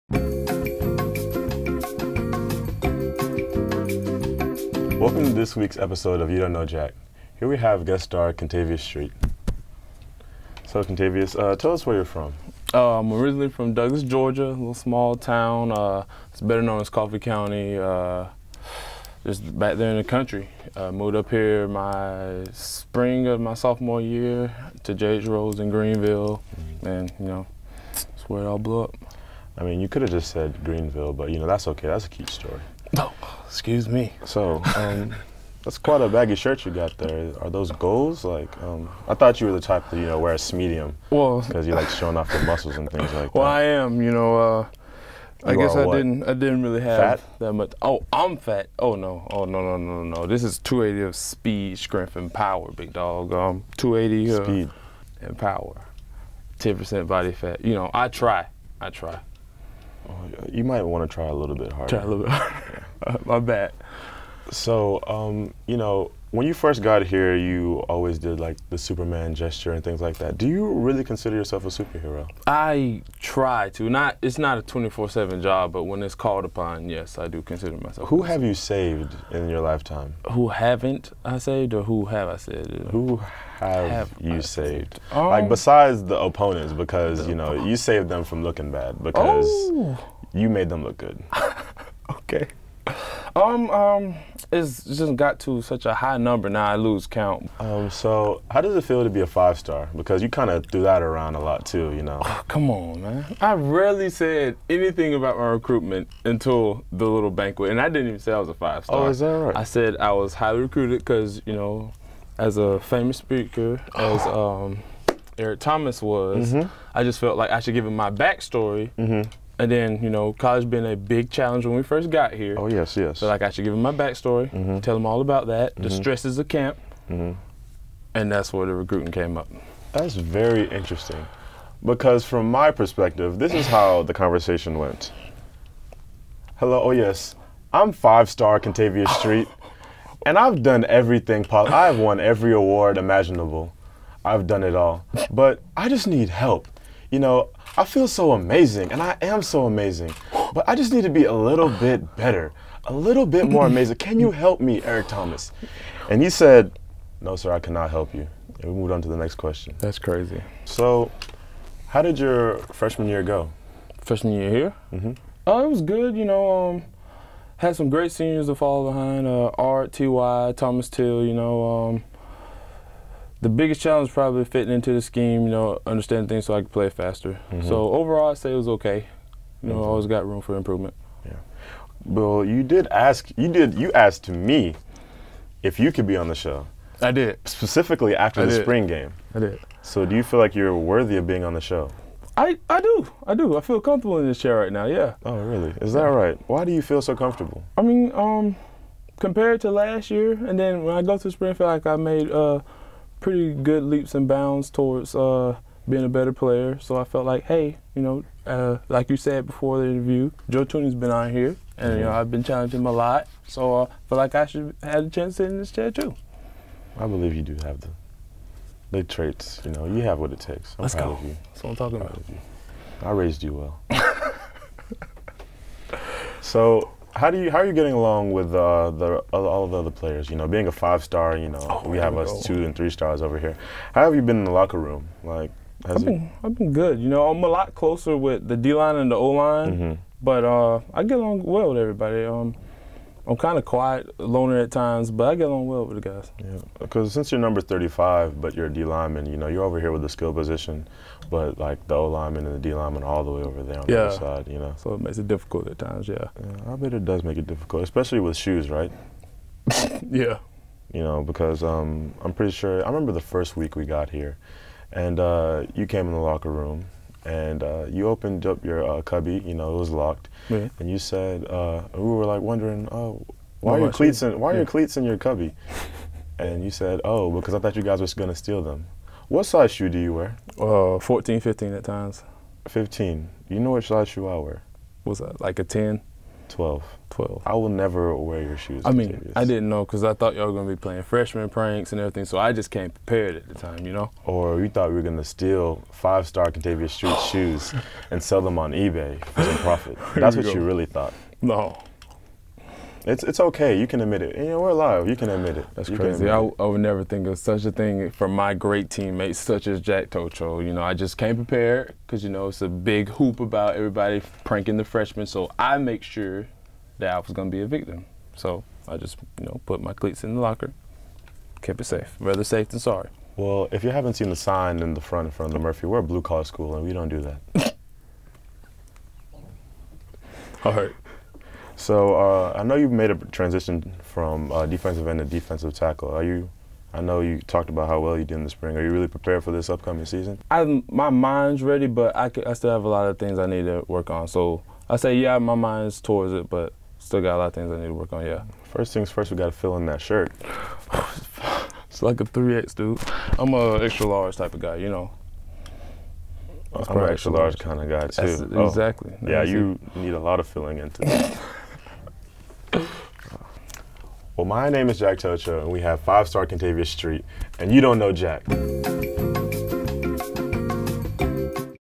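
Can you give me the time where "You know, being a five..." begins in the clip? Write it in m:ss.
3:50.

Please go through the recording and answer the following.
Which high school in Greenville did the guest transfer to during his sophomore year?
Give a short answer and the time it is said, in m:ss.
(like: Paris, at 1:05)
J.H. Rose, at 0:24.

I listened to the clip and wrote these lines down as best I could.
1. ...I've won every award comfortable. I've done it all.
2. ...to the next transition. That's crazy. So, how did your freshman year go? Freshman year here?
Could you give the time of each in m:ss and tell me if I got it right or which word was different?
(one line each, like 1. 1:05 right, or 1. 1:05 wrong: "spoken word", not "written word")
1. 2:21 wrong: "imaginable", not "comfortable"
2. 2:39 wrong: "question", not "transition".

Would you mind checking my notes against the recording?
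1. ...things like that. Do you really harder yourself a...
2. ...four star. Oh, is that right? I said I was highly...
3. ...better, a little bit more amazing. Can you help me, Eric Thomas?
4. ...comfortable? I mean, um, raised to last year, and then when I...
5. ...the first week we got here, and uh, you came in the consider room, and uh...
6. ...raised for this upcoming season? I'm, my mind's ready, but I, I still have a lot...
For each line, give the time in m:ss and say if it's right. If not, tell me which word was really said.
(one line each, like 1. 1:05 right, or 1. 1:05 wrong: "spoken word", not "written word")
1. 1:09 wrong: "consider", not "harder"
2. 1:48 wrong: "five", not "four"
3. 2:32 right
4. 3:17 wrong: "compared", not "raised"
5. 4:23 wrong: "locker", not "consider"
6. 5:39 wrong: "prepared", not "raised".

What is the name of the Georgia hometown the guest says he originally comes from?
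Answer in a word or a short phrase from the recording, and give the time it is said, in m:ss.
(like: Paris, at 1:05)
Douglas, at 0:13.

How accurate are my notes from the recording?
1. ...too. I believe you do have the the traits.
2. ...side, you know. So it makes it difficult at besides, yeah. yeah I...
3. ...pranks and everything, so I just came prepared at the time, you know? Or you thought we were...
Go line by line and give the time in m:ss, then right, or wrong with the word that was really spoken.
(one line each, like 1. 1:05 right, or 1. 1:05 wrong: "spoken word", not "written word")
1. 3:35 right
2. 4:14 wrong: "times", not "besides"
3. 4:51 right.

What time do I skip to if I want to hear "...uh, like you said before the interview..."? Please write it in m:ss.
3:28.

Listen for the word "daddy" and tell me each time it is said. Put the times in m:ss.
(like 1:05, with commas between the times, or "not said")
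not said.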